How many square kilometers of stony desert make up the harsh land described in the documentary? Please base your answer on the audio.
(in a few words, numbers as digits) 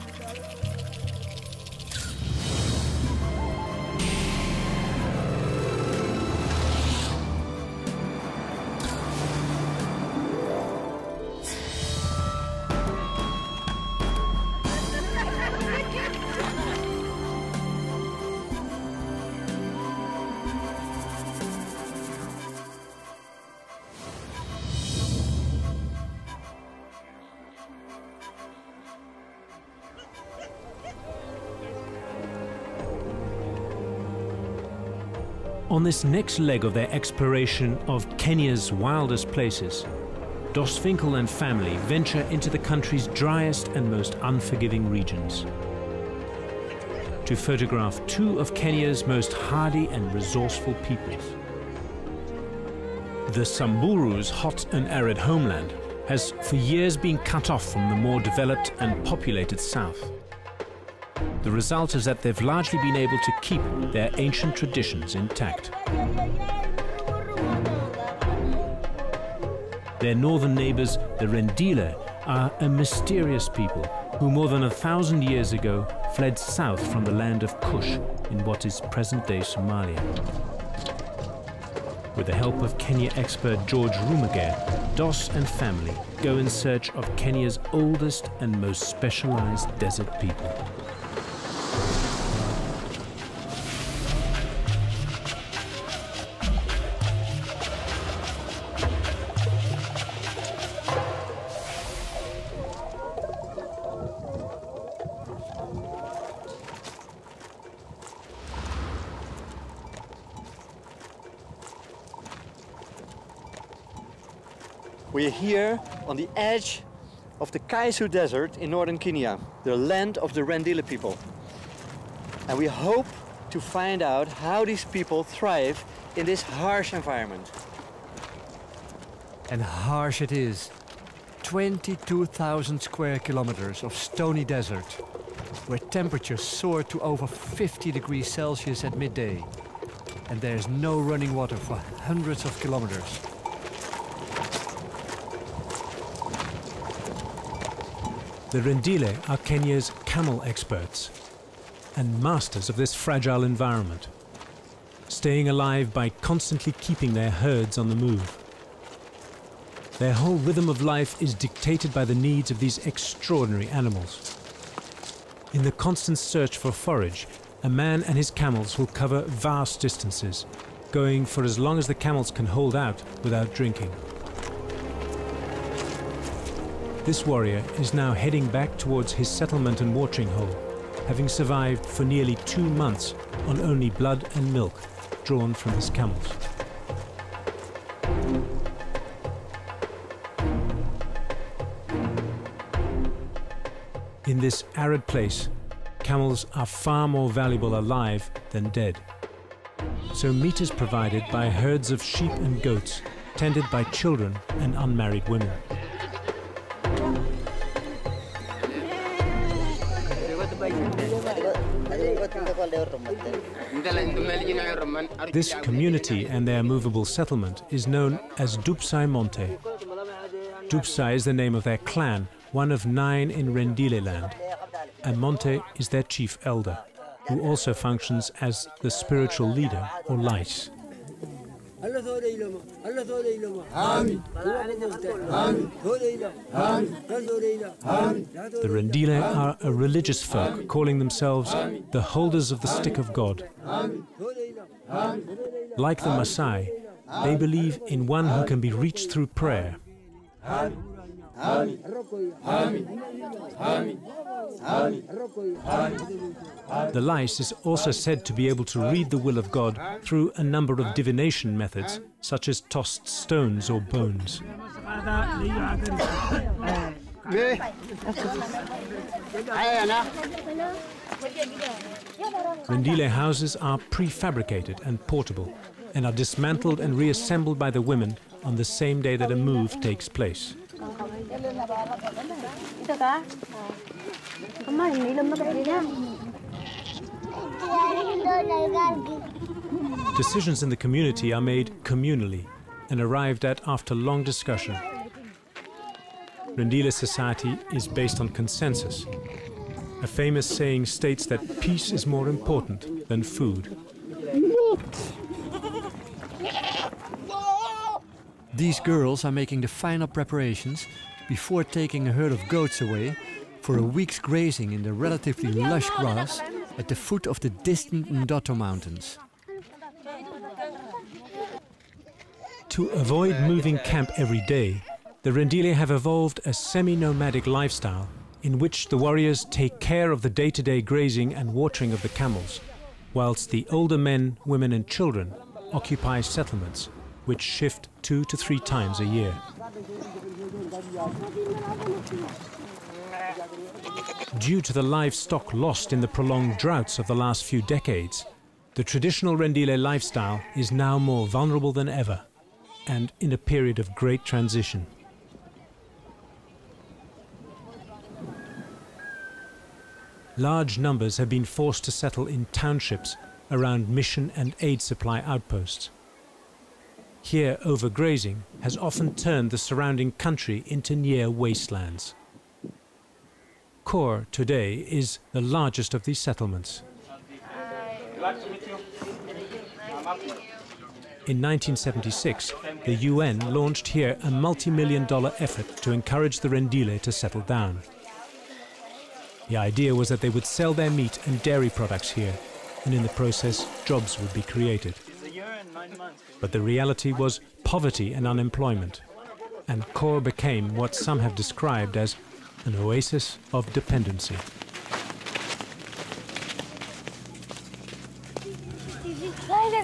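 22,000.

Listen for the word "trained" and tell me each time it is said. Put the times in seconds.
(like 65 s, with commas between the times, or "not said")
not said.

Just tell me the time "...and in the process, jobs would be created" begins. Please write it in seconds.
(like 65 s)
392 s.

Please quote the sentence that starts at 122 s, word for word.
And we hope to find out how these people thrive in this harsh environment.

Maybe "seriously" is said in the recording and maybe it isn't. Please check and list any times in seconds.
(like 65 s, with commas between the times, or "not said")
not said.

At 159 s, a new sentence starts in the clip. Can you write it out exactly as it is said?
Their whole rhythm of life is dictated by the needs of these extraordinary animals.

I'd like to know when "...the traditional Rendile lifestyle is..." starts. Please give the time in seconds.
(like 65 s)
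348 s.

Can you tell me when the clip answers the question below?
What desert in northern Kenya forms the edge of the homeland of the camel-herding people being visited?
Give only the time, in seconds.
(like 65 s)
117 s.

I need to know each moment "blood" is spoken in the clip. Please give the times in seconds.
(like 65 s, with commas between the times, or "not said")
183 s.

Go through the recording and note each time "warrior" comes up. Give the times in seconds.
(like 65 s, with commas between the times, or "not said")
177 s, 328 s.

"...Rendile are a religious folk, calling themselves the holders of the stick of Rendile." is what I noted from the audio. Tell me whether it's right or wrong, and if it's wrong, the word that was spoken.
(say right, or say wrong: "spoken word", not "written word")
wrong: "God", not "Rendile".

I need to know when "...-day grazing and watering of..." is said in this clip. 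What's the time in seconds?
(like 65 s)
330 s.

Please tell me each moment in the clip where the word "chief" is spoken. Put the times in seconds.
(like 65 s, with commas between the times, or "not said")
226 s.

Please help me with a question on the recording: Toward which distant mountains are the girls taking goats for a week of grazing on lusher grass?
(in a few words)
Ndoto Mountains.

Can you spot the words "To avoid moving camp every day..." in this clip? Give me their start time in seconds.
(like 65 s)
322 s.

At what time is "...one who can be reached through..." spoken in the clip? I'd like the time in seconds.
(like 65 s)
248 s.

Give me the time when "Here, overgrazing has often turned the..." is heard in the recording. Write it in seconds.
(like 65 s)
367 s.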